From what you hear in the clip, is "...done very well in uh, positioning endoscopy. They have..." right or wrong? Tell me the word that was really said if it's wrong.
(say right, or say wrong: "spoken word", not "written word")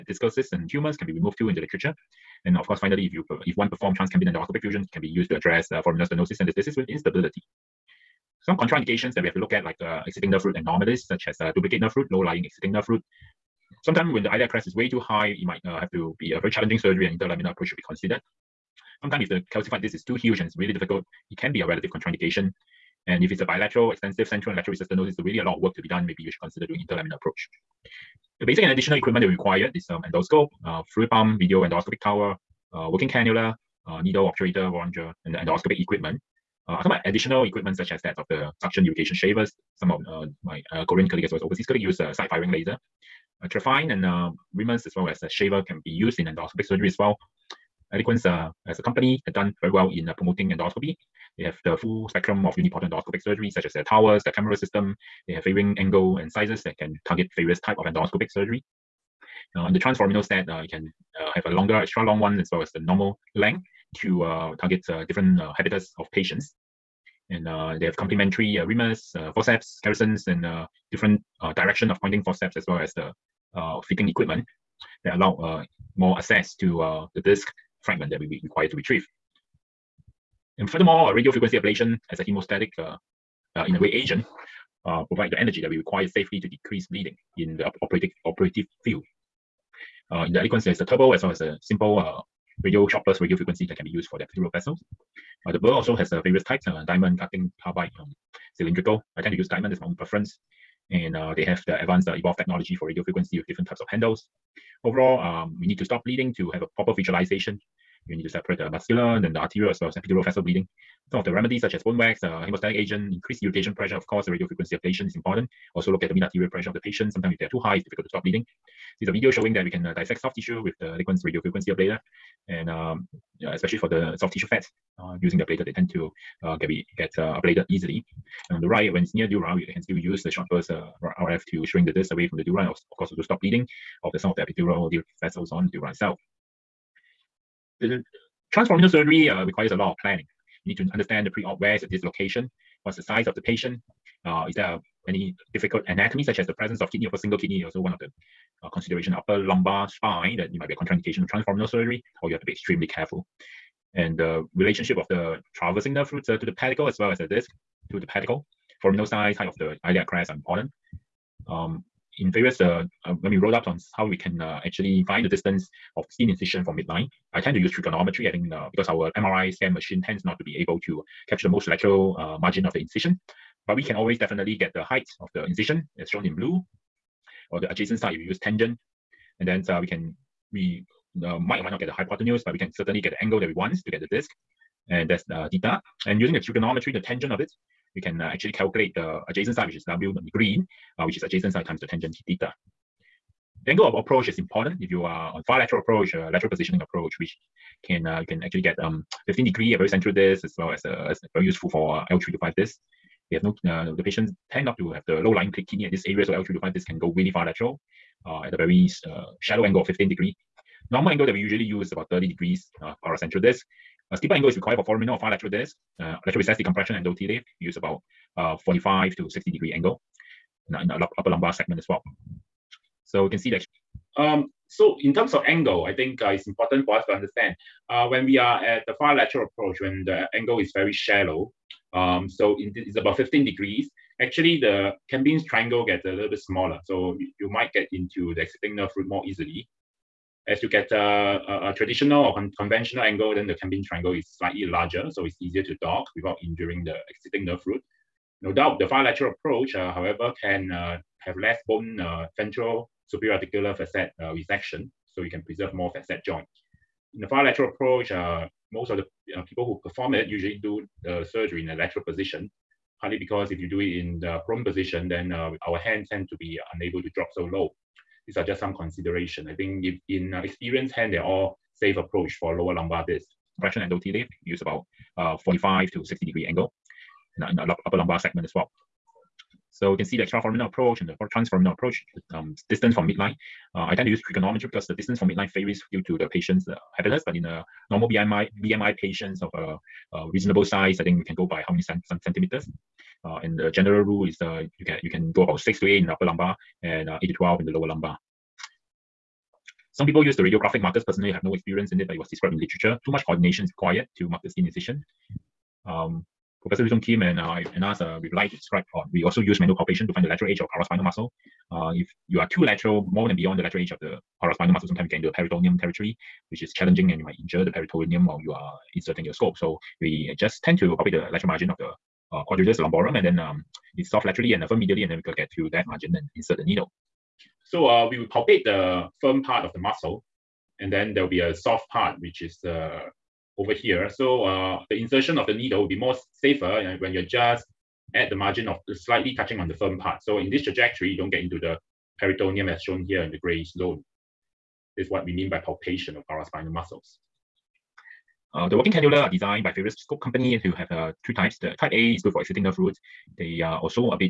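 wrong: "promoting", not "positioning".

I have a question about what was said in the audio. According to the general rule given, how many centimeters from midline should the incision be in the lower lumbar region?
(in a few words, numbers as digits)
8 to 12.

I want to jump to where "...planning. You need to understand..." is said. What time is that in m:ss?
2:20.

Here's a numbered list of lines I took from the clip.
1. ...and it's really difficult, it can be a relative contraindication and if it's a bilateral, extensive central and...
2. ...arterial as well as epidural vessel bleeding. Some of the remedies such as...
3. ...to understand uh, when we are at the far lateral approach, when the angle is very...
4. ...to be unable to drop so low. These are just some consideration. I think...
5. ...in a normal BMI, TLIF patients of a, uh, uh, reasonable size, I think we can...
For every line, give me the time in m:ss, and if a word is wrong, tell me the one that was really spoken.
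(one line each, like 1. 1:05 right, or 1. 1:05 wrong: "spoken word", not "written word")
1. 0:20 right
2. 1:49 right
3. 3:47 right
4. 4:26 right
5. 4:47 wrong: "BMI", not "TLIF".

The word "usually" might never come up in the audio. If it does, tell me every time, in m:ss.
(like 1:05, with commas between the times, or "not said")
3:31, 4:20.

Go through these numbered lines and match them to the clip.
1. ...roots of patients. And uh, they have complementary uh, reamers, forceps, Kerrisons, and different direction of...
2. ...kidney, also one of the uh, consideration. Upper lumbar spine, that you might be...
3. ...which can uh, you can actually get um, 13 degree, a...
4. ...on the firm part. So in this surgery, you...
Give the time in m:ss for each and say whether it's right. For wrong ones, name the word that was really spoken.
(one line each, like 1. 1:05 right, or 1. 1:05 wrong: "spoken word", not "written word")
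1. 1:05 wrong: "habitats", not "roots"
2. 2:27 right
3. 3:17 wrong: "15", not "13"
4. 5:39 wrong: "trajectory", not "surgery".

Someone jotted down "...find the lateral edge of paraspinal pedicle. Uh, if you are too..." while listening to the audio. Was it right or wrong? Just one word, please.
wrong.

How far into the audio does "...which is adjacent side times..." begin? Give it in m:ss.
3:11.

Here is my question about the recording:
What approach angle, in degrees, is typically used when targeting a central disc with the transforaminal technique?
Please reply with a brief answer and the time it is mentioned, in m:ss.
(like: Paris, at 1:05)
30 degrees, at 3:32.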